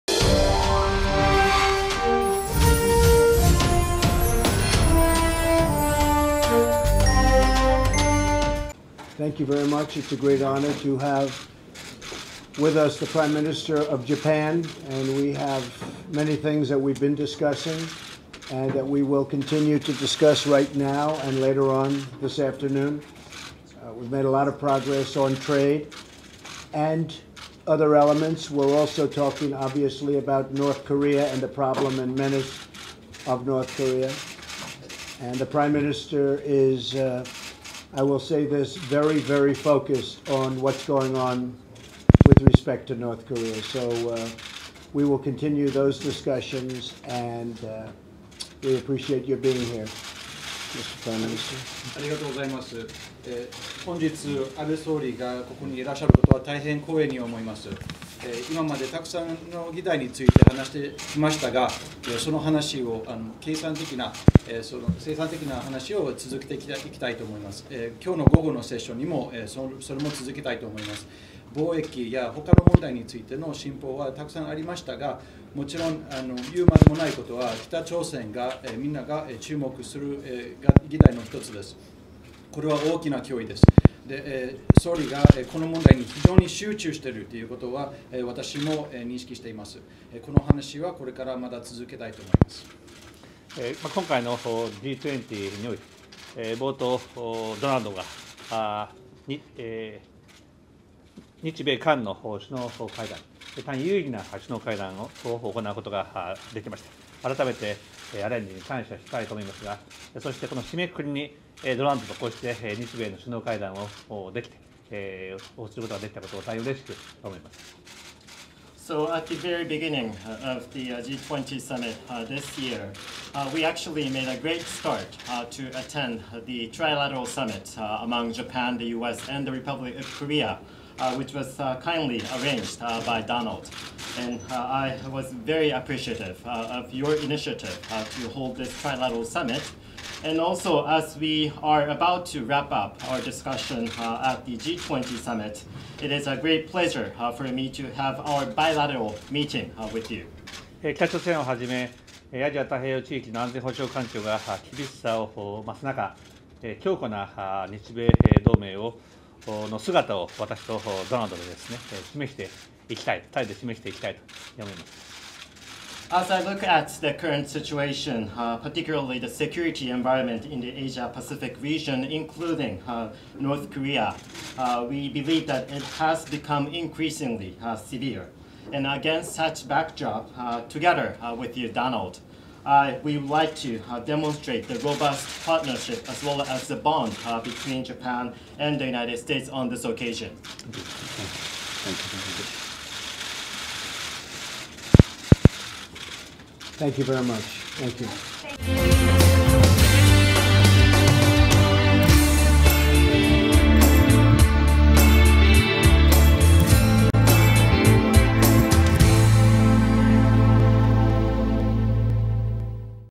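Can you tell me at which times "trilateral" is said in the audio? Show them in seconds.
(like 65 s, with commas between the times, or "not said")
126 s, 138 s.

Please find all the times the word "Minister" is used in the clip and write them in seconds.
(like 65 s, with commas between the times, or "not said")
13 s, 35 s, 51 s.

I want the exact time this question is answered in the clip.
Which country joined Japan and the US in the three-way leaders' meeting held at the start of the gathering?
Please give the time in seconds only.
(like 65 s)
129 s.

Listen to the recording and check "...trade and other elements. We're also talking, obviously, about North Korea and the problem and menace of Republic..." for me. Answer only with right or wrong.
wrong.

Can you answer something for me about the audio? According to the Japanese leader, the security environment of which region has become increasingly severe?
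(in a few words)
Asia-Pacific.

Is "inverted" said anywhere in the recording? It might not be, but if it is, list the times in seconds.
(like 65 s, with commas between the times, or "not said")
not said.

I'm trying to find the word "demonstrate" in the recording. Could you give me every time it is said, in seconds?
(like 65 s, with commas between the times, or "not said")
184 s.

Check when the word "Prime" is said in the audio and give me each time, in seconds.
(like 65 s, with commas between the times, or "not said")
13 s, 35 s, 51 s.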